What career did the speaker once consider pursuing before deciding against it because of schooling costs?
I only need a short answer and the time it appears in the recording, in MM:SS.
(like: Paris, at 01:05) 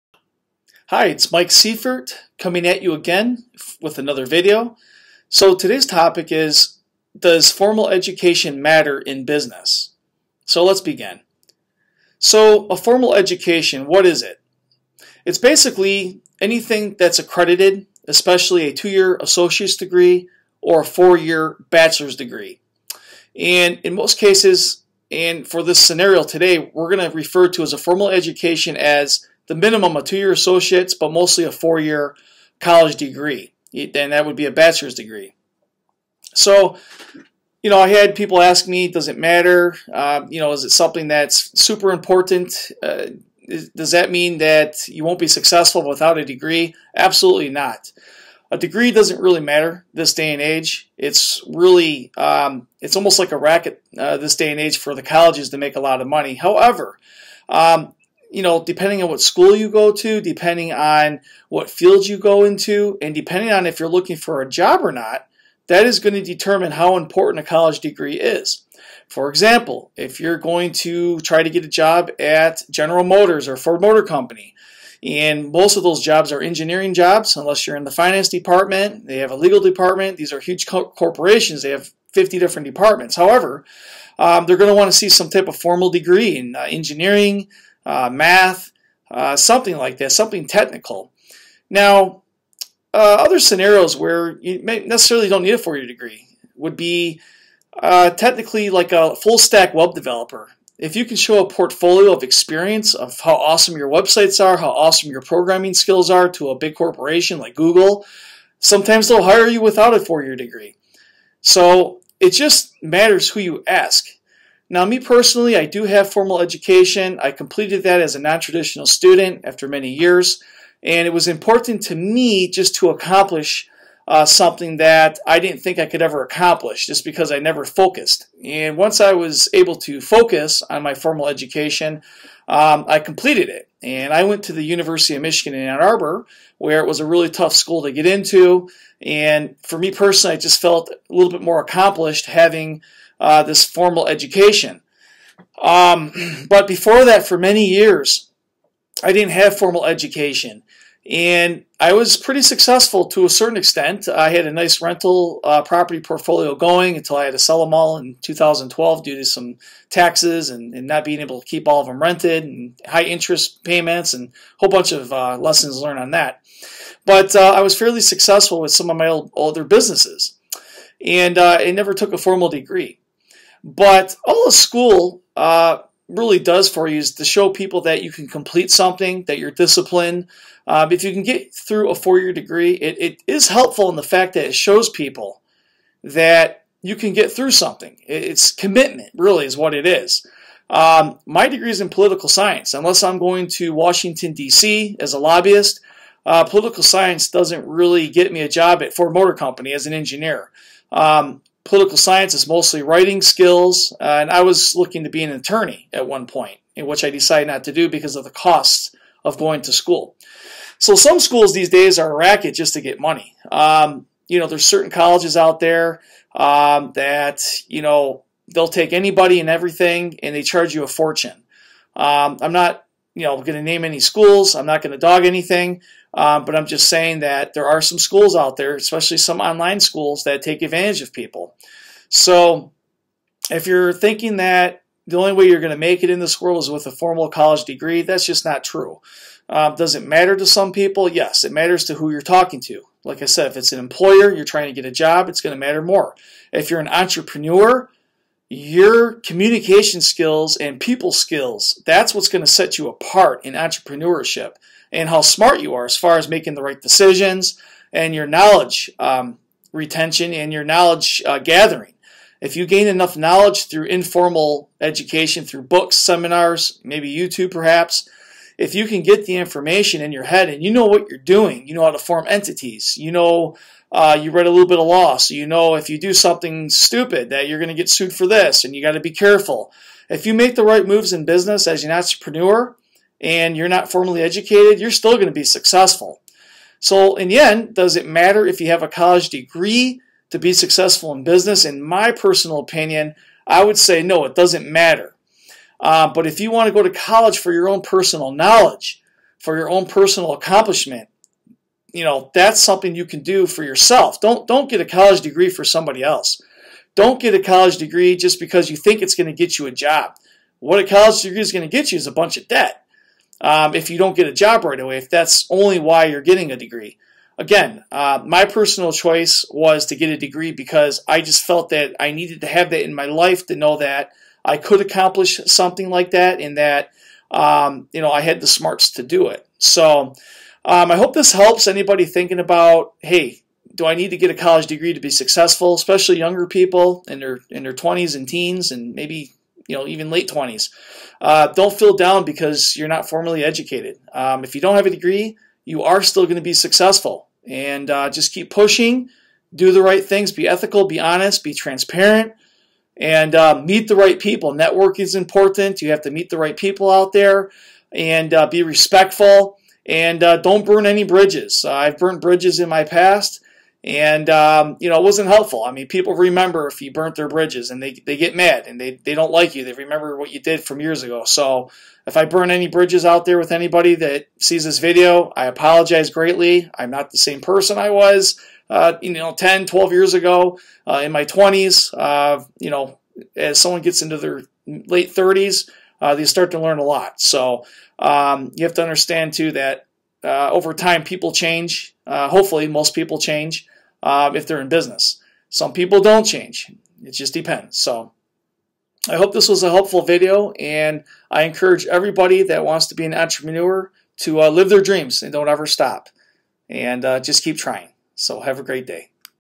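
Attorney, at 03:25.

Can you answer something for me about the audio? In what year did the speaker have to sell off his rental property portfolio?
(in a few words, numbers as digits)
2012.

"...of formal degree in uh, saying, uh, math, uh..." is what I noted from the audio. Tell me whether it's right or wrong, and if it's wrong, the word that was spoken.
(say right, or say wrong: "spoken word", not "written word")
wrong: "engineering", not "saying".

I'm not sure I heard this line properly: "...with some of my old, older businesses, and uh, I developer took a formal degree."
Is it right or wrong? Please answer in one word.
wrong.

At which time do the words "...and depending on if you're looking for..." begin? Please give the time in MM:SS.
01:03.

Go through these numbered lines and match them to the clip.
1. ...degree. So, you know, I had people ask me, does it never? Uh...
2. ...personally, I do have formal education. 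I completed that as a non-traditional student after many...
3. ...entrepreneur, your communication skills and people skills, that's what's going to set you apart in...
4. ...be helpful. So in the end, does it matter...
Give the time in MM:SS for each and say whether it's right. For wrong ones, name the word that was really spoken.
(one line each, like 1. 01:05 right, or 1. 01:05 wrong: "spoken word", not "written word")
1. 00:34 wrong: "matter", not "never"
2. 01:55 right
3. 04:06 right
4. 04:45 wrong: "successful", not "helpful".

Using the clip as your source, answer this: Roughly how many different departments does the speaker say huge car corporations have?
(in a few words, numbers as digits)
50.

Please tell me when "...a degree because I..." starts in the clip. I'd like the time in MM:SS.
05:20.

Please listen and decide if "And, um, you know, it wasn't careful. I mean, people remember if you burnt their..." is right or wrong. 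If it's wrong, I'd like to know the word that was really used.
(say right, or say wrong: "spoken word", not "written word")
wrong: "helpful", not "careful".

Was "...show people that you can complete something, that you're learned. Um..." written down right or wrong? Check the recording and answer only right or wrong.
wrong.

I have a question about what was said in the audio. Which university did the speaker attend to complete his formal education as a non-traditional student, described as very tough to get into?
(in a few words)
University of Michigan.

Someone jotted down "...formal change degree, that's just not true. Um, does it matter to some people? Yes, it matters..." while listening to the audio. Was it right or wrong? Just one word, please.
wrong.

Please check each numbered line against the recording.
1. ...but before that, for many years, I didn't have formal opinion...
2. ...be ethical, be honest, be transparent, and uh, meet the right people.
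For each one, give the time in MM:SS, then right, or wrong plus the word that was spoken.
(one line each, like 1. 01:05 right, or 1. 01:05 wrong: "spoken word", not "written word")
1. 02:26 wrong: "education", not "opinion"
2. 05:50 right.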